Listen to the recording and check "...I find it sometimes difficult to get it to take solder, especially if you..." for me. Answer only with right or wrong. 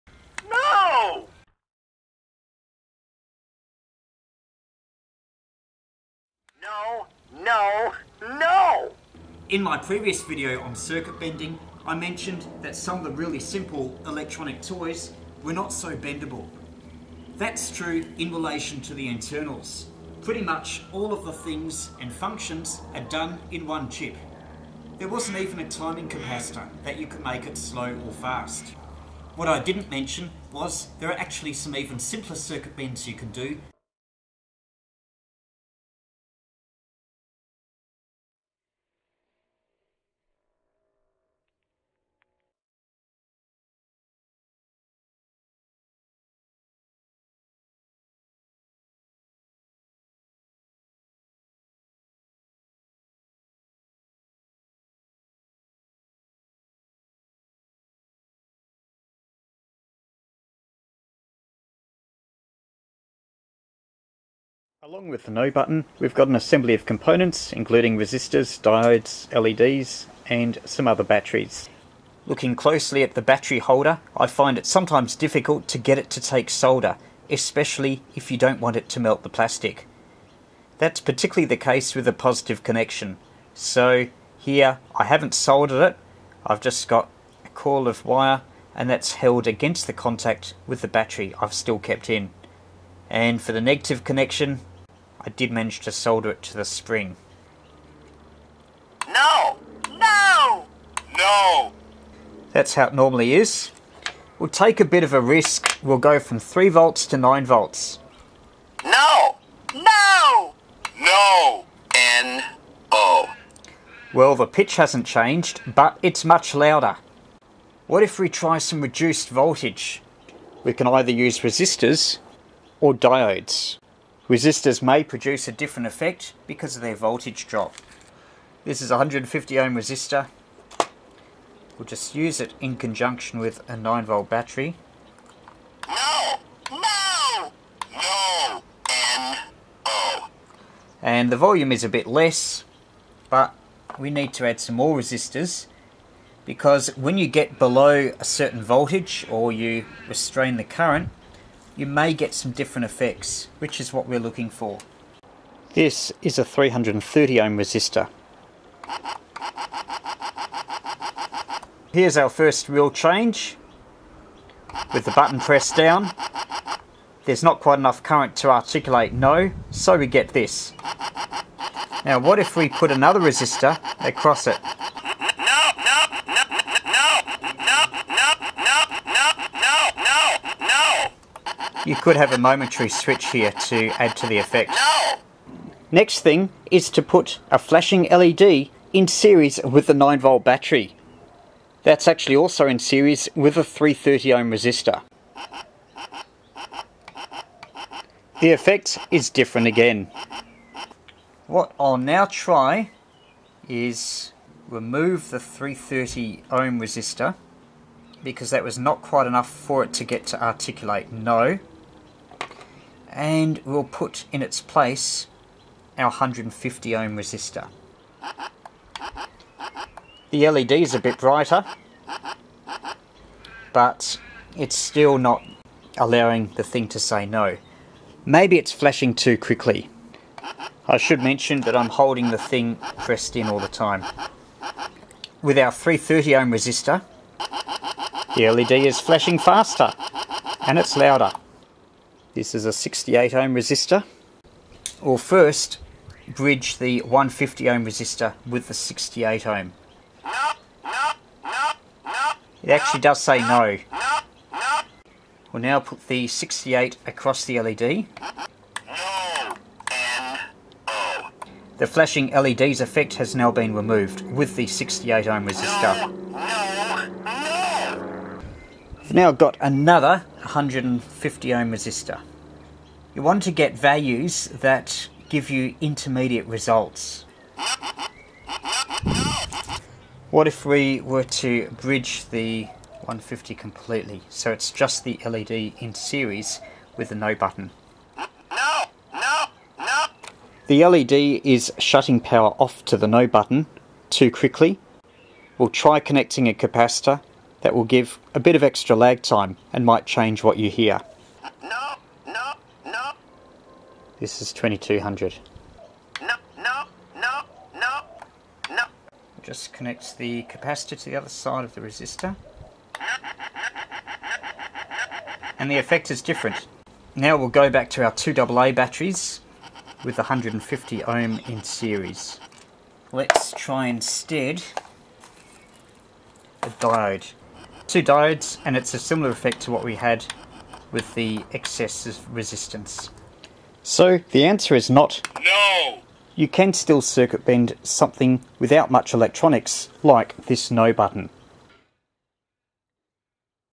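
right.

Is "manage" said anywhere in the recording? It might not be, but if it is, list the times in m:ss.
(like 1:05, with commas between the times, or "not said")
1:35.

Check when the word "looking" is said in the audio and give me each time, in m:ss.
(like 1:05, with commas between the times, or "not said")
1:12, 2:34.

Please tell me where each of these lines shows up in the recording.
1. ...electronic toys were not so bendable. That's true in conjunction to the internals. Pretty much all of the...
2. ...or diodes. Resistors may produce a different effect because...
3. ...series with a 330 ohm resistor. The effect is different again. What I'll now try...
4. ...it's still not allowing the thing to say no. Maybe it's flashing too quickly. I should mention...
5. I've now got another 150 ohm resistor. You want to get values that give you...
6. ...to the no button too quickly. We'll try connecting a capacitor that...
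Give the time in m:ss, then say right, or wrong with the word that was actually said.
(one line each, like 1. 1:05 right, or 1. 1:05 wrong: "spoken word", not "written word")
1. 0:14 wrong: "relation", not "conjunction"
2. 2:02 right
3. 3:12 right
4. 3:44 right
5. 4:29 right
6. 4:52 right.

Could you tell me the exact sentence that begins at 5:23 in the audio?
Let's try instead a diode two diodes and it's a similar effect to what we had with the excess resistance.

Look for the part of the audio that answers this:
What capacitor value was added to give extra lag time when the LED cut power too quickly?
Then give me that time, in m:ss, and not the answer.
5:04.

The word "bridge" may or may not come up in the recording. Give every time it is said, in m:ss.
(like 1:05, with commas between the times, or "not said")
4:06, 4:41.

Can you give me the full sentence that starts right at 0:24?
There wasn't even a timing capacitor that you could make it slow or fast.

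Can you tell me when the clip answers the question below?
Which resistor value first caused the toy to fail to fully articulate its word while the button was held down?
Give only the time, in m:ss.
2:36.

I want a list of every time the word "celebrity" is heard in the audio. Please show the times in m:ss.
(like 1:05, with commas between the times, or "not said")
not said.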